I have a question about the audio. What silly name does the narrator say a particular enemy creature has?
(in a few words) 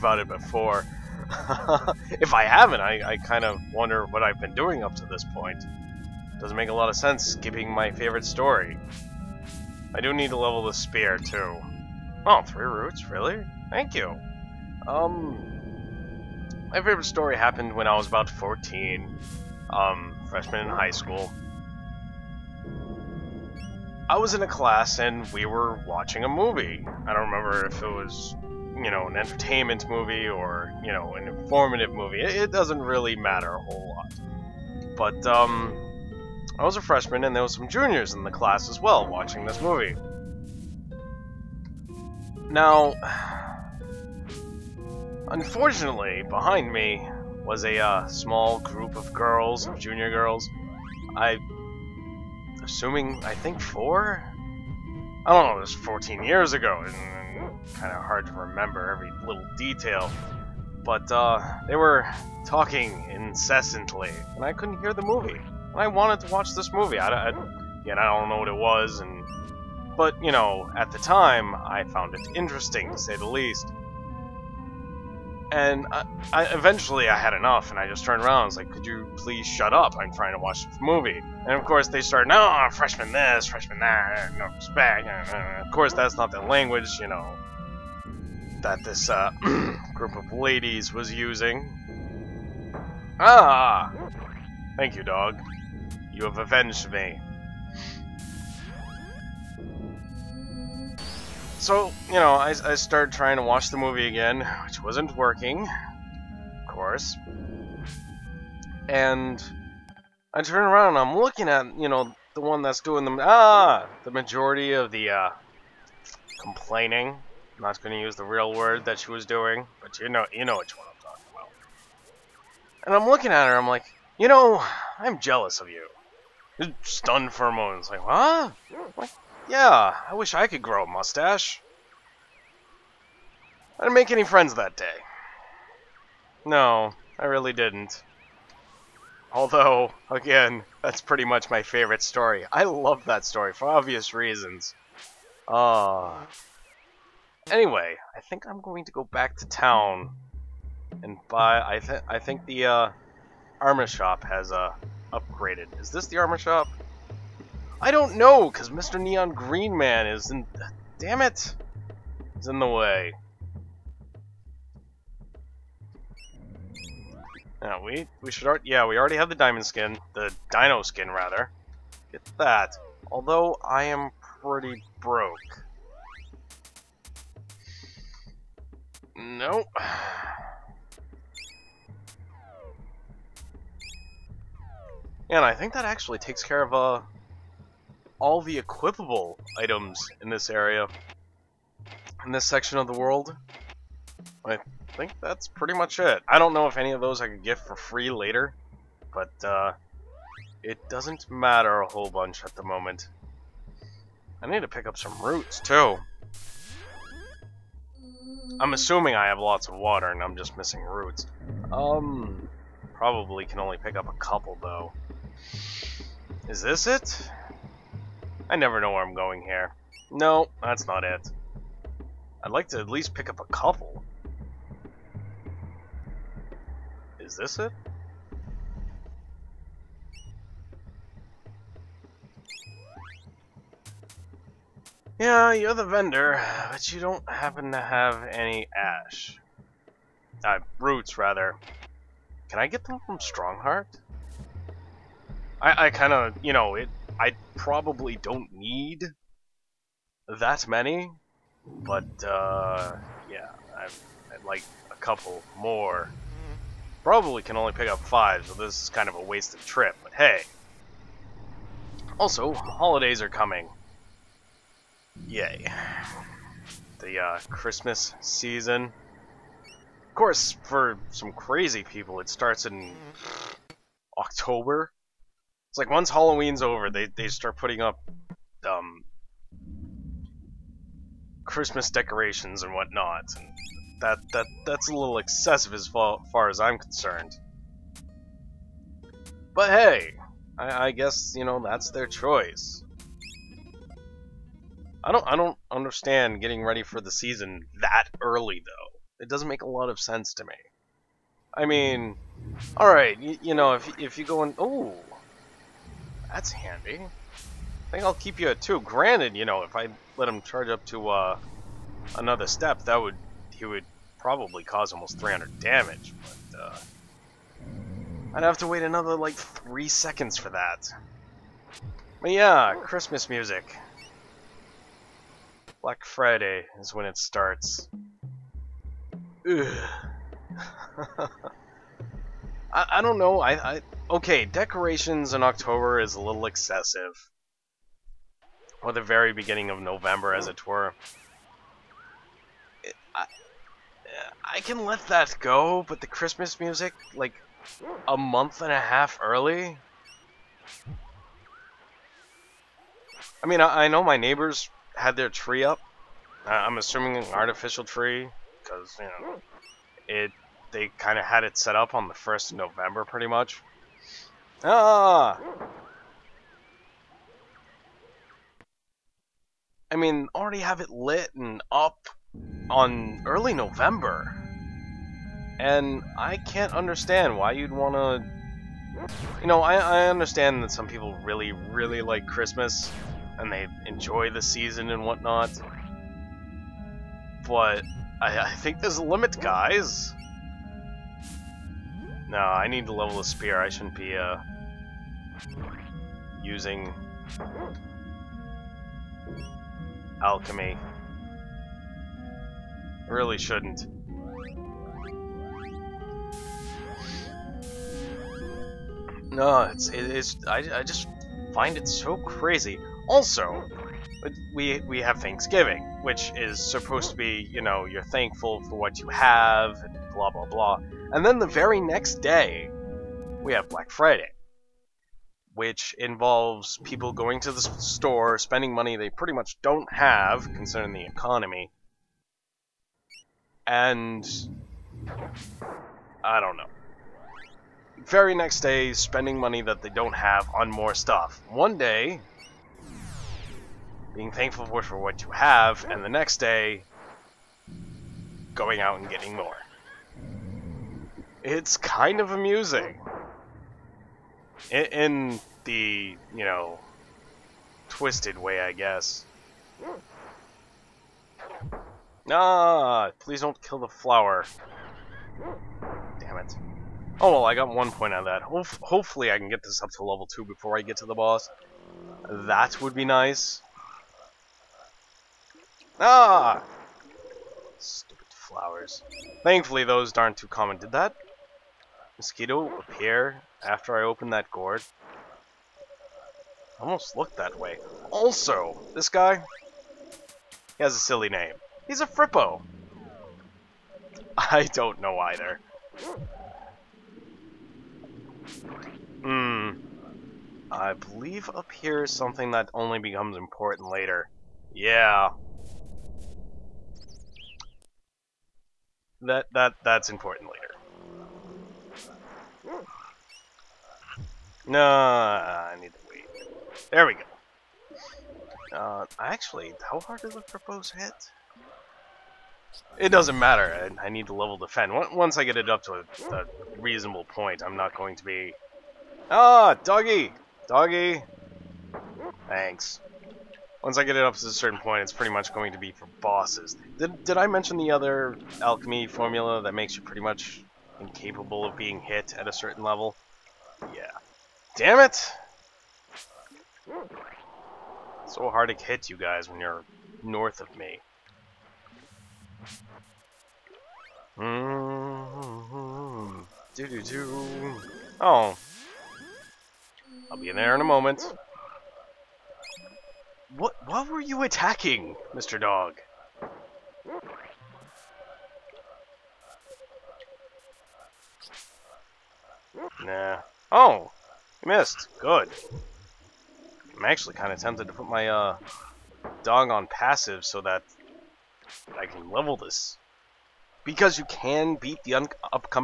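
Frippo.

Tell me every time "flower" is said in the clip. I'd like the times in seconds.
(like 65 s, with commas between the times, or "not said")
463 s, 478 s.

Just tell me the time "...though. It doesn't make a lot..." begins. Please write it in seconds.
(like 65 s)
298 s.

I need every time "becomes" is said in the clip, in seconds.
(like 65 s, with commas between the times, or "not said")
502 s.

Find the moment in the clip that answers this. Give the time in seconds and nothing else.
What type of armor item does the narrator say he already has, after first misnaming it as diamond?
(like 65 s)
170 s.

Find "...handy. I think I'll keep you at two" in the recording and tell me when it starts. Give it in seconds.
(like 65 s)
306 s.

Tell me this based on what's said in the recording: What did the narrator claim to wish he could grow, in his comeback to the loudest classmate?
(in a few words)
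A mustache.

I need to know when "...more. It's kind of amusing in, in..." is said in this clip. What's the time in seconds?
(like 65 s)
449 s.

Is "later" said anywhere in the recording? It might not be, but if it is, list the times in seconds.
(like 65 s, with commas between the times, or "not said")
198 s, 503 s, 510 s.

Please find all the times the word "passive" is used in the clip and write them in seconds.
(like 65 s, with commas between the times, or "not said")
579 s.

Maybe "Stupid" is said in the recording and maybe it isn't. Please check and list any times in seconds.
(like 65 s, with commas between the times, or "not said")
477 s.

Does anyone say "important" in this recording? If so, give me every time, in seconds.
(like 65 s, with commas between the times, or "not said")
503 s, 510 s.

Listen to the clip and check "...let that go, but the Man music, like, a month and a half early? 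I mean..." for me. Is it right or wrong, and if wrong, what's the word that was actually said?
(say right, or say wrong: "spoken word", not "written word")
wrong: "Christmas", not "Man".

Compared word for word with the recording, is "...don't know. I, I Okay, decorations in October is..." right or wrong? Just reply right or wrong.
right.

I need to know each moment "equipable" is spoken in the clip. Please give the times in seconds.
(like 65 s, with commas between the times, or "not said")
188 s.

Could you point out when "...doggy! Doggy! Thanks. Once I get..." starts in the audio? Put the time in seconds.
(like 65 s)
529 s.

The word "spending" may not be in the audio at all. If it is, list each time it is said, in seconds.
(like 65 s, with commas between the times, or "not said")
428 s, 438 s.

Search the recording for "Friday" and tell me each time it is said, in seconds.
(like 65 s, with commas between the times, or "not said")
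326 s, 423 s.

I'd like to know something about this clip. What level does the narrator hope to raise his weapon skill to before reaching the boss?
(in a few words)
2.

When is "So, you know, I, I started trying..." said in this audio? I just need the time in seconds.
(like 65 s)
101 s.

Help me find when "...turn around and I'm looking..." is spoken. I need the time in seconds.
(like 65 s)
110 s.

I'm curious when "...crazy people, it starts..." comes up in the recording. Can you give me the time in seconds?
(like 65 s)
271 s.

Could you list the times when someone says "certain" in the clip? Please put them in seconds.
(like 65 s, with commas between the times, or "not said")
534 s, 542 s.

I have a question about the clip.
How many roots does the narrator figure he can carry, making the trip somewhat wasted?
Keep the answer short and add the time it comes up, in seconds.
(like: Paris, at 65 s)
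5, at 257 s.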